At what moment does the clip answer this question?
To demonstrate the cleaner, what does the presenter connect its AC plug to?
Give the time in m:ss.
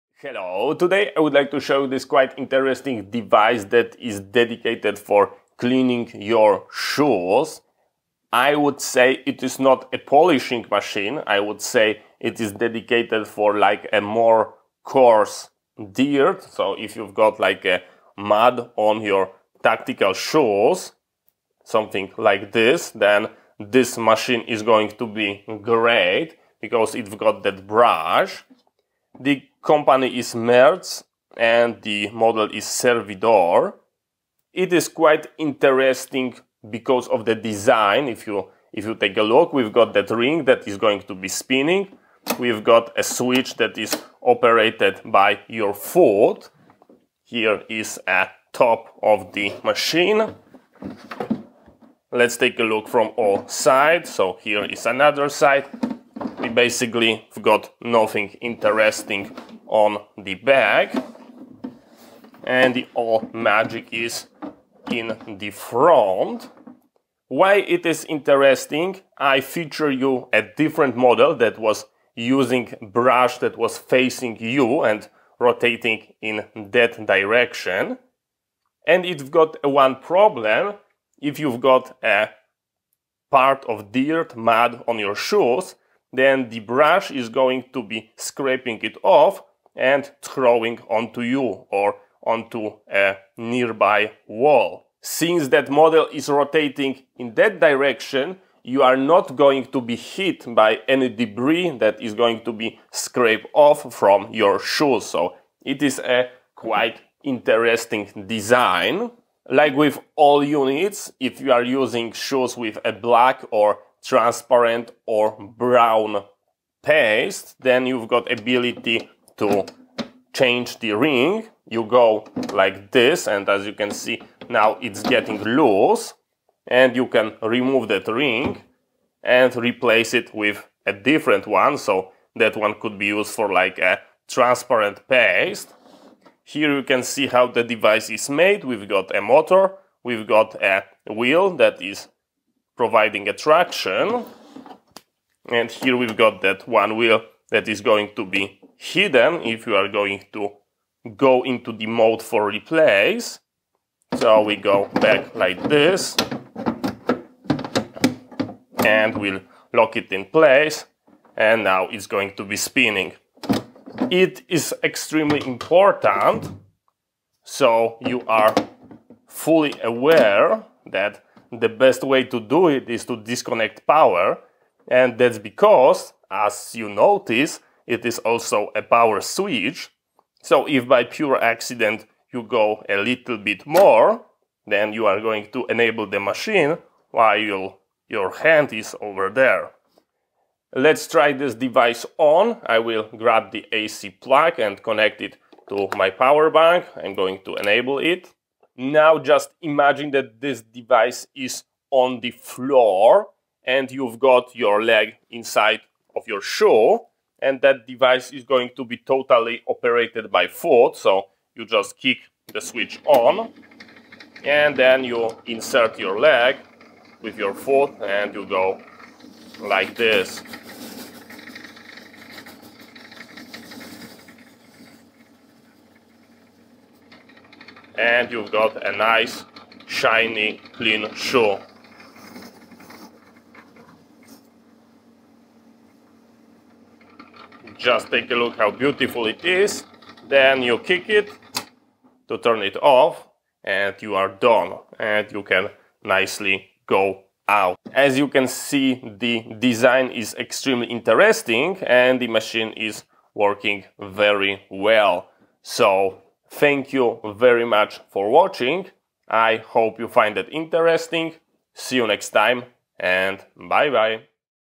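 3:16.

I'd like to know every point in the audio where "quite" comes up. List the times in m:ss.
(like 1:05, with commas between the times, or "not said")
0:02, 0:34, 1:46.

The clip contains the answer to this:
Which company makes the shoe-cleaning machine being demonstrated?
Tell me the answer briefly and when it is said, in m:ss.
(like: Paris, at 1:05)
Merz, at 0:30.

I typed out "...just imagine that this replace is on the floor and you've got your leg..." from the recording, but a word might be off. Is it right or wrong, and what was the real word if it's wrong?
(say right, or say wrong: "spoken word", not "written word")
wrong: "device", not "replace".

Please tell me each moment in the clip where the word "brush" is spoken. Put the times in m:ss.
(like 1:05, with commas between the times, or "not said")
0:27, 1:12, 1:26.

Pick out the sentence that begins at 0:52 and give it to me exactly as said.
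Let's take a look from all sides.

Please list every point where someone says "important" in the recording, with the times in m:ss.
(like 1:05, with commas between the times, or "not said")
2:45.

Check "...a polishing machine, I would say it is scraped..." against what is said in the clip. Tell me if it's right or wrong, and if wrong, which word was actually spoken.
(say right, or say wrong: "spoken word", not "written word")
wrong: "dedicated", not "scraped".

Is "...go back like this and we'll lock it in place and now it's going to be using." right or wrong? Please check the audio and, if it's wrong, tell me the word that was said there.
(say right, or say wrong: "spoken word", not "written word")
wrong: "spinning", not "using".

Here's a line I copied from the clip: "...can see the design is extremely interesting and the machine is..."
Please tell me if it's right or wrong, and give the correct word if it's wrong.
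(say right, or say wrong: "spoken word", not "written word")
right.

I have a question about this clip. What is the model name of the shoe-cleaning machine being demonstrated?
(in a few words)
Servidor.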